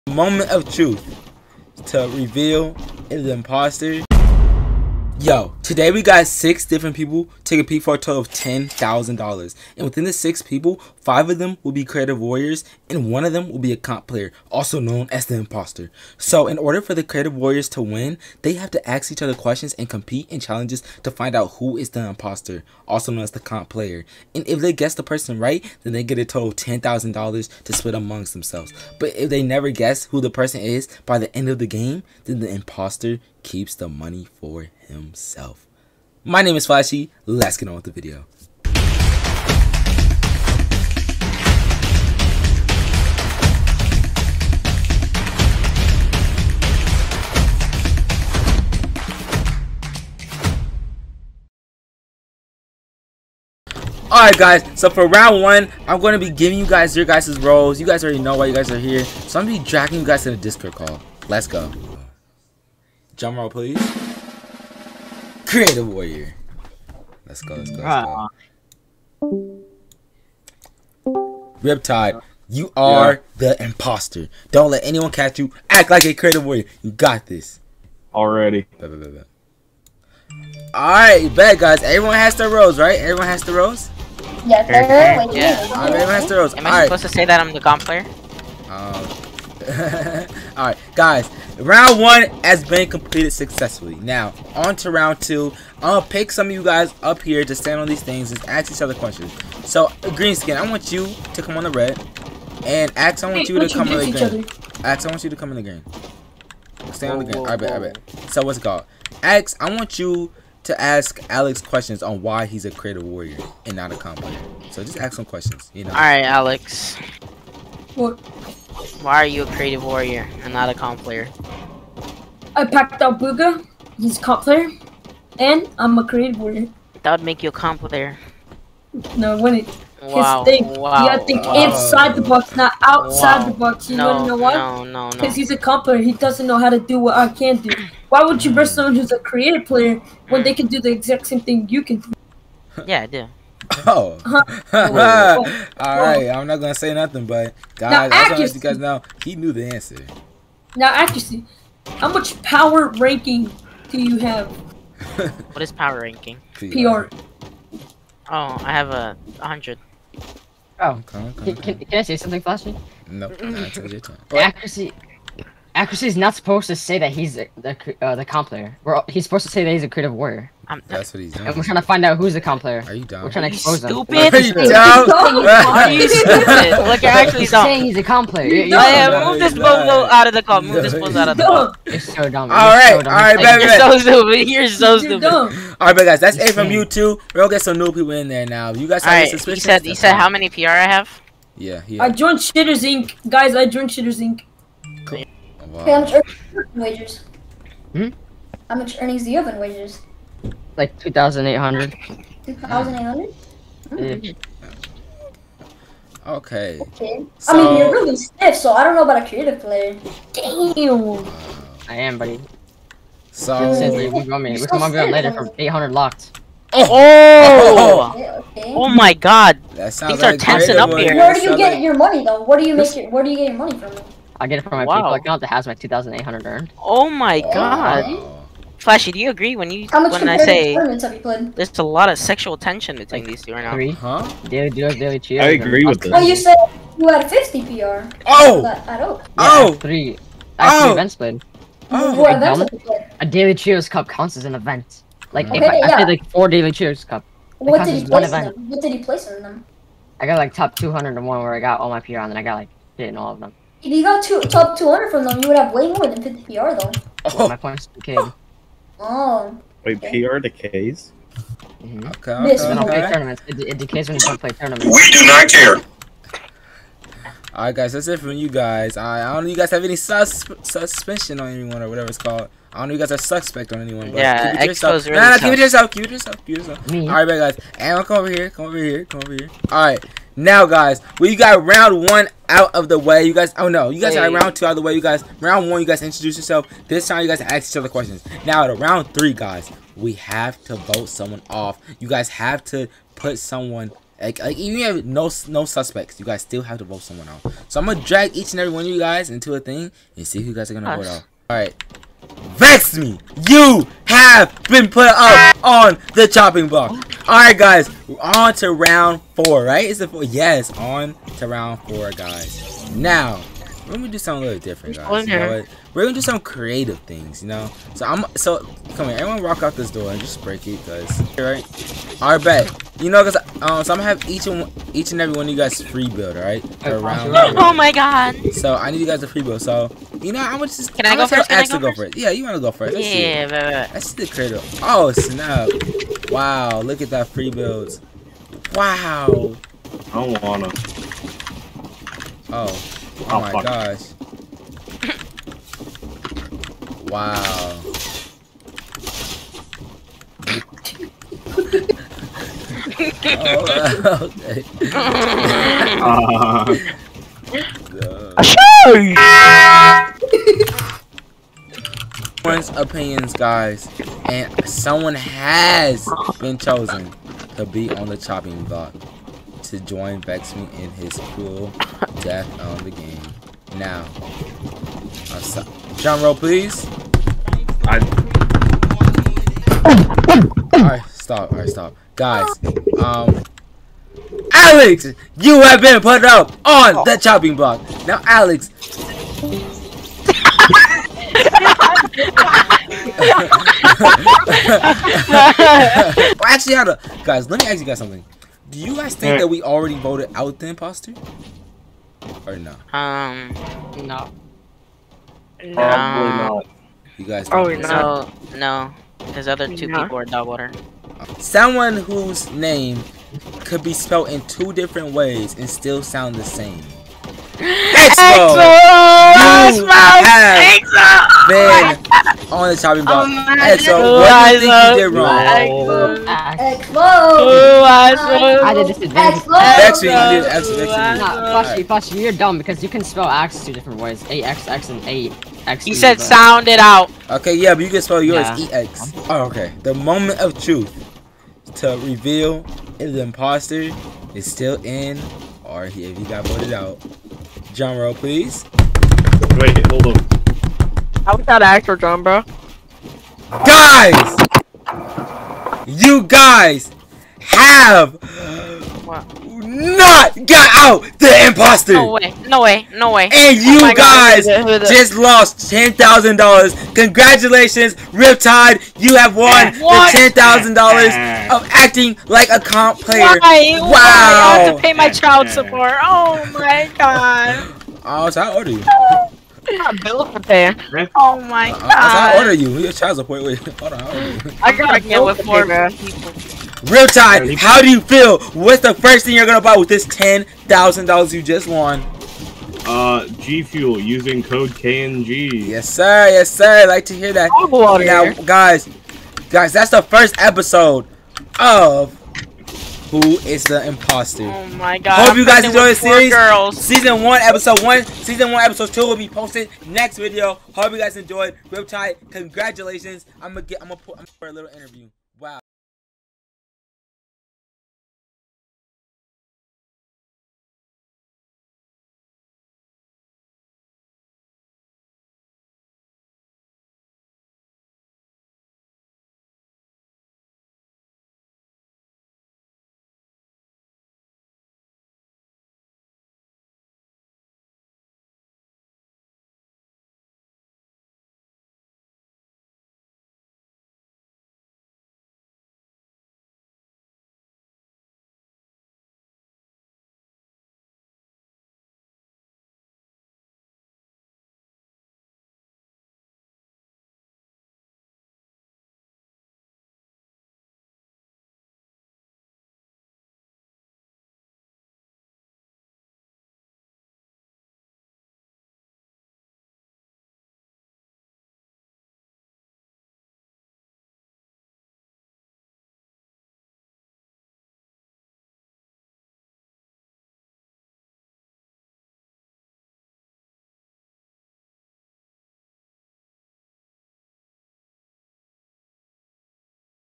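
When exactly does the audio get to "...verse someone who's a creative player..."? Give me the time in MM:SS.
02:18.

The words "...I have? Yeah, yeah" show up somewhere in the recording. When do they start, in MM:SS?
03:10.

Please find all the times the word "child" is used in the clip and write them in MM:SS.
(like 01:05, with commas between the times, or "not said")
07:55, 08:02.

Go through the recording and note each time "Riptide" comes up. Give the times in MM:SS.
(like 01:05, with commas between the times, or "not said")
01:11, 07:48.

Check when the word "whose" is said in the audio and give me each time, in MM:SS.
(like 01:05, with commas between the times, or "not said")
06:51.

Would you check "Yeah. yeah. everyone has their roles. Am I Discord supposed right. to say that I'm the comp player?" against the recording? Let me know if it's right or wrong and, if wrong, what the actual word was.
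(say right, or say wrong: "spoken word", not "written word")
wrong: "All", not "Discord".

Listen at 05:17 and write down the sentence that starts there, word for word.
So I'm so come here, everyone, walk out this door and just break it, guys.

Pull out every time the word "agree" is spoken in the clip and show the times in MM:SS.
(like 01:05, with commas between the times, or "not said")
03:49, 03:55.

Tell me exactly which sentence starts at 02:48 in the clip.
All, he's supposed to say that he's a creative warrior.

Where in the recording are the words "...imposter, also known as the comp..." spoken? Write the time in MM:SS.
00:22.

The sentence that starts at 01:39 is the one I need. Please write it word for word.
So, green skin, I want you to come on the red.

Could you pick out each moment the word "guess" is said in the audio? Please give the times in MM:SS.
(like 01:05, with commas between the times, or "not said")
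00:24, 00:29.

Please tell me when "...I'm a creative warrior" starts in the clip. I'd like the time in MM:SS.
02:05.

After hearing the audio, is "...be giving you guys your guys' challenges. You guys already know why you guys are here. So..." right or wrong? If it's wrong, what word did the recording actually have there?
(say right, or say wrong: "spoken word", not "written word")
wrong: "roles", not "challenges".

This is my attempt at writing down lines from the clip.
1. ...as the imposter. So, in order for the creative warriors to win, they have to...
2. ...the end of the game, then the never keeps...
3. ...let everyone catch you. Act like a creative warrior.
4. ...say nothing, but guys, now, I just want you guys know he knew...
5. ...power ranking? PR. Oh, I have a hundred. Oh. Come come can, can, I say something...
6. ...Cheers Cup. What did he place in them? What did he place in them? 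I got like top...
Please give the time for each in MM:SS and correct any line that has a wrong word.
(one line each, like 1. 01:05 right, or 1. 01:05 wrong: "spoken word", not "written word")
1. 00:15 right
2. 00:31 wrong: "imposter", not "never"
3. 01:14 wrong: "anyone", not "everyone"
4. 02:26 right
5. 02:35 right
6. 04:06 right.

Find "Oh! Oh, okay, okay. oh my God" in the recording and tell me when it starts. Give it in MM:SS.
03:36.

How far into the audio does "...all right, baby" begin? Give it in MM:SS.
03:02.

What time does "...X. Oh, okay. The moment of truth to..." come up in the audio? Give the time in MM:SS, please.
07:18.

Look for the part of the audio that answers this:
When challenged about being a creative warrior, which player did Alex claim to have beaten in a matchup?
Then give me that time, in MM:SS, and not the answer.
02:02.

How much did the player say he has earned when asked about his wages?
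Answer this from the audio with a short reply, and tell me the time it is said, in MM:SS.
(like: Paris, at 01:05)
2,800, at 03:20.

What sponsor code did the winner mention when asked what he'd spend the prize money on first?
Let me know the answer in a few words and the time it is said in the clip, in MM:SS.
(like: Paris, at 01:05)
KNG, at 08:13.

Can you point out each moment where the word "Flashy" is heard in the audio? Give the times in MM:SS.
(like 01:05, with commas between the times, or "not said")
00:36, 02:42, 03:48.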